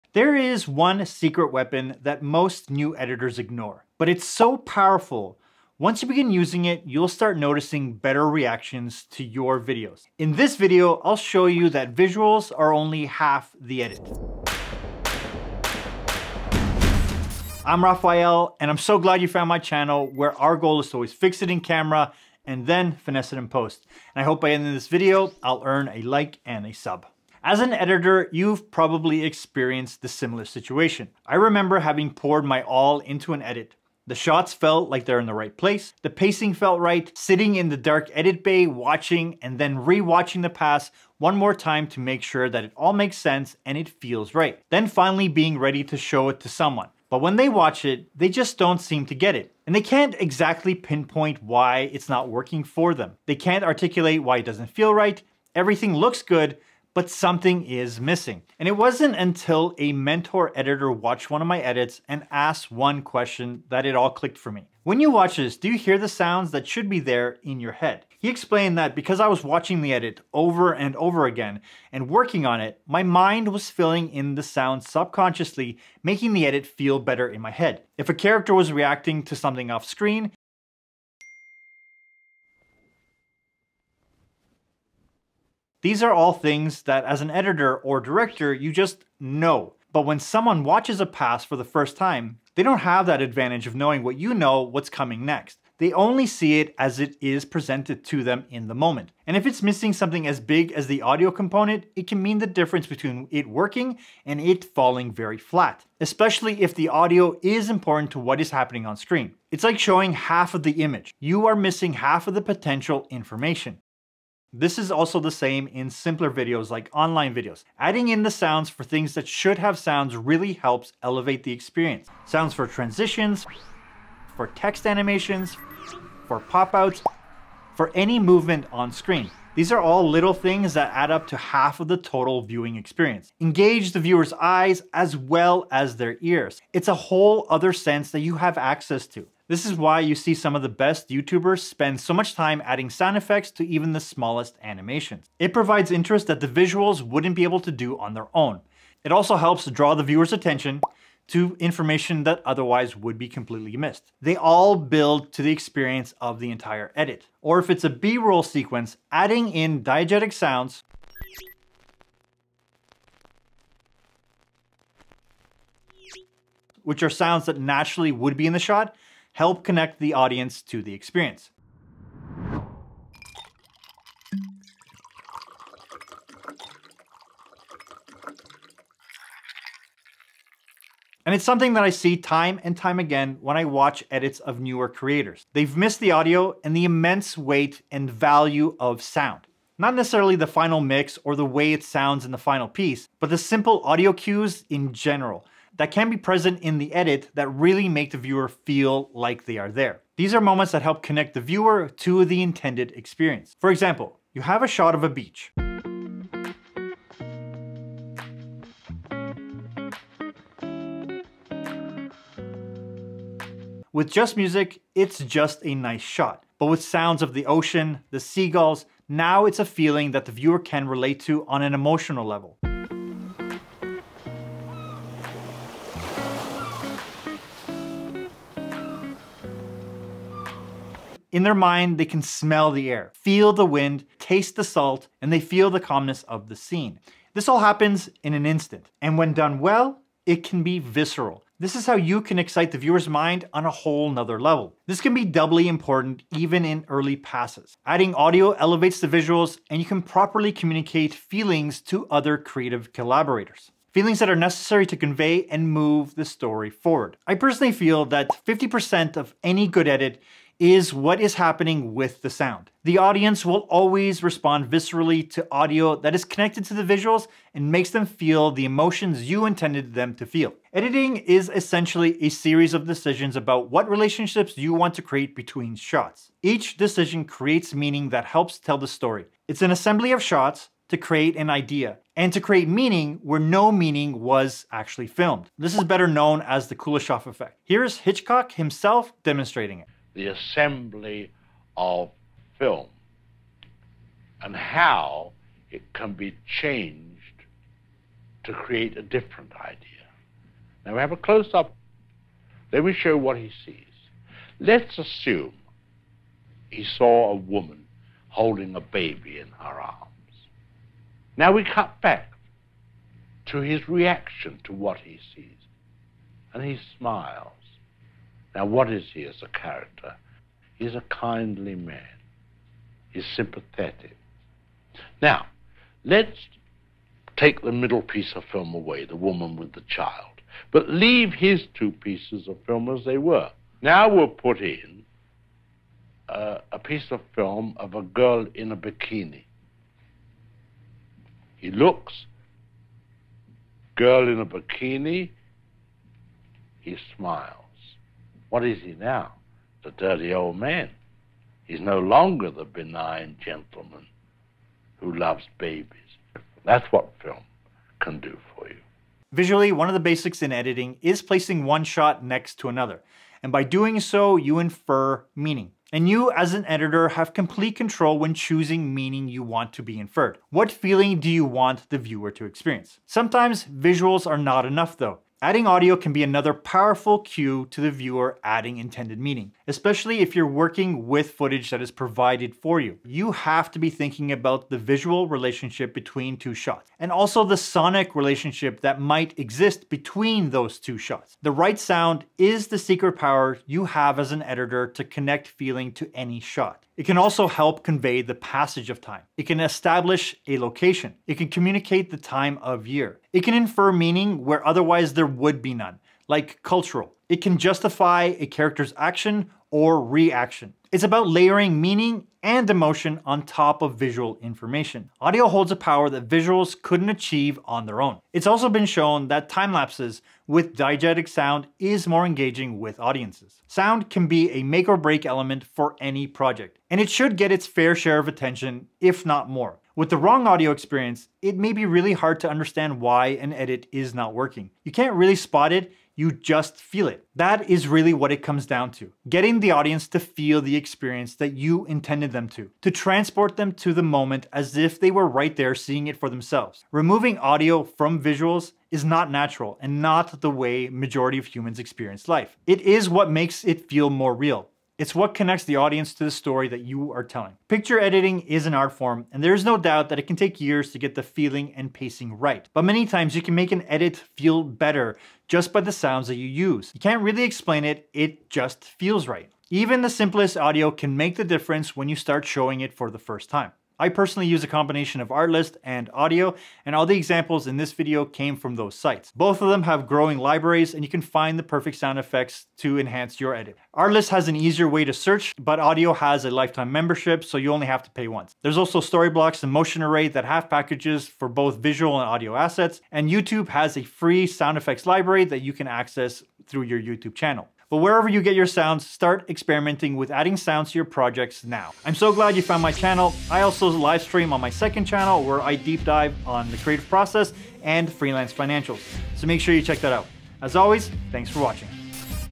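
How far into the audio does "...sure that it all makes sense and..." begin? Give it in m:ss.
0:42.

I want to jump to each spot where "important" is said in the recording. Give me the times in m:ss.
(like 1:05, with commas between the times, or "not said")
1:47, 4:05.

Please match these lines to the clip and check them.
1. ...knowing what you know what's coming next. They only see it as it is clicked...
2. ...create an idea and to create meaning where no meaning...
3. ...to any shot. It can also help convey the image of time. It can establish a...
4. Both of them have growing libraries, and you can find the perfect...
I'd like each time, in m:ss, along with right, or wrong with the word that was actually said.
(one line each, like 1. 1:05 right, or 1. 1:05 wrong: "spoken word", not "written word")
1. 1:33 wrong: "presented", not "clicked"
2. 4:40 right
3. 6:35 wrong: "passage", not "image"
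4. 7:59 right.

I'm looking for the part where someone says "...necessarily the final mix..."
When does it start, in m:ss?
3:09.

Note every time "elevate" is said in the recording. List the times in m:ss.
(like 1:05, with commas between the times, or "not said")
2:01, 4:08.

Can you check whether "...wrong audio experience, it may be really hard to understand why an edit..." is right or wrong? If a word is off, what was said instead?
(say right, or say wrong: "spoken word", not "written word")
right.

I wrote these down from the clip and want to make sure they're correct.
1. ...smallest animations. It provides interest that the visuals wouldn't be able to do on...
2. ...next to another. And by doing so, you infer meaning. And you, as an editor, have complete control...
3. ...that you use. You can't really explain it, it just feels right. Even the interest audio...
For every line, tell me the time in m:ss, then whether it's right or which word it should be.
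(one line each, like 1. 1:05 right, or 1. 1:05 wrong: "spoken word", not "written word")
1. 2:23 right
2. 6:02 right
3. 7:46 wrong: "simplest", not "interest".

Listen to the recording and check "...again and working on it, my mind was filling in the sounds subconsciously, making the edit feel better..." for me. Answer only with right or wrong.
right.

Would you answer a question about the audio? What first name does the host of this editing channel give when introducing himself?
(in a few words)
Rafael.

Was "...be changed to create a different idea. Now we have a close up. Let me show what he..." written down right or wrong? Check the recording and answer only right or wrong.
right.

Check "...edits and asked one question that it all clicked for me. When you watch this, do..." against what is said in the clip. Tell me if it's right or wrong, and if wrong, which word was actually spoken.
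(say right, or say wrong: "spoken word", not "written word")
right.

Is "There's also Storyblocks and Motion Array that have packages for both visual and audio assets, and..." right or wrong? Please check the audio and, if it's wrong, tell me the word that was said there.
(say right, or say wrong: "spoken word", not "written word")
right.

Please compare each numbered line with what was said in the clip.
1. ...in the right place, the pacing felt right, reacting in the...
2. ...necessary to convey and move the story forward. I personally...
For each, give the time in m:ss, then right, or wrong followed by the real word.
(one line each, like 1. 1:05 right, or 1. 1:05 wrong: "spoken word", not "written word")
1. 0:35 wrong: "sitting", not "reacting"
2. 4:14 right.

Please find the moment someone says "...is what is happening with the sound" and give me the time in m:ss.
4:20.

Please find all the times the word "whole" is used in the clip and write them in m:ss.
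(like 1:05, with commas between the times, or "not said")
2:16, 4:03.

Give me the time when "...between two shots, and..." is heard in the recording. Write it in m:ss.
6:25.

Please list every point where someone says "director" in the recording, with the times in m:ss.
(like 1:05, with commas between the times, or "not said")
1:27.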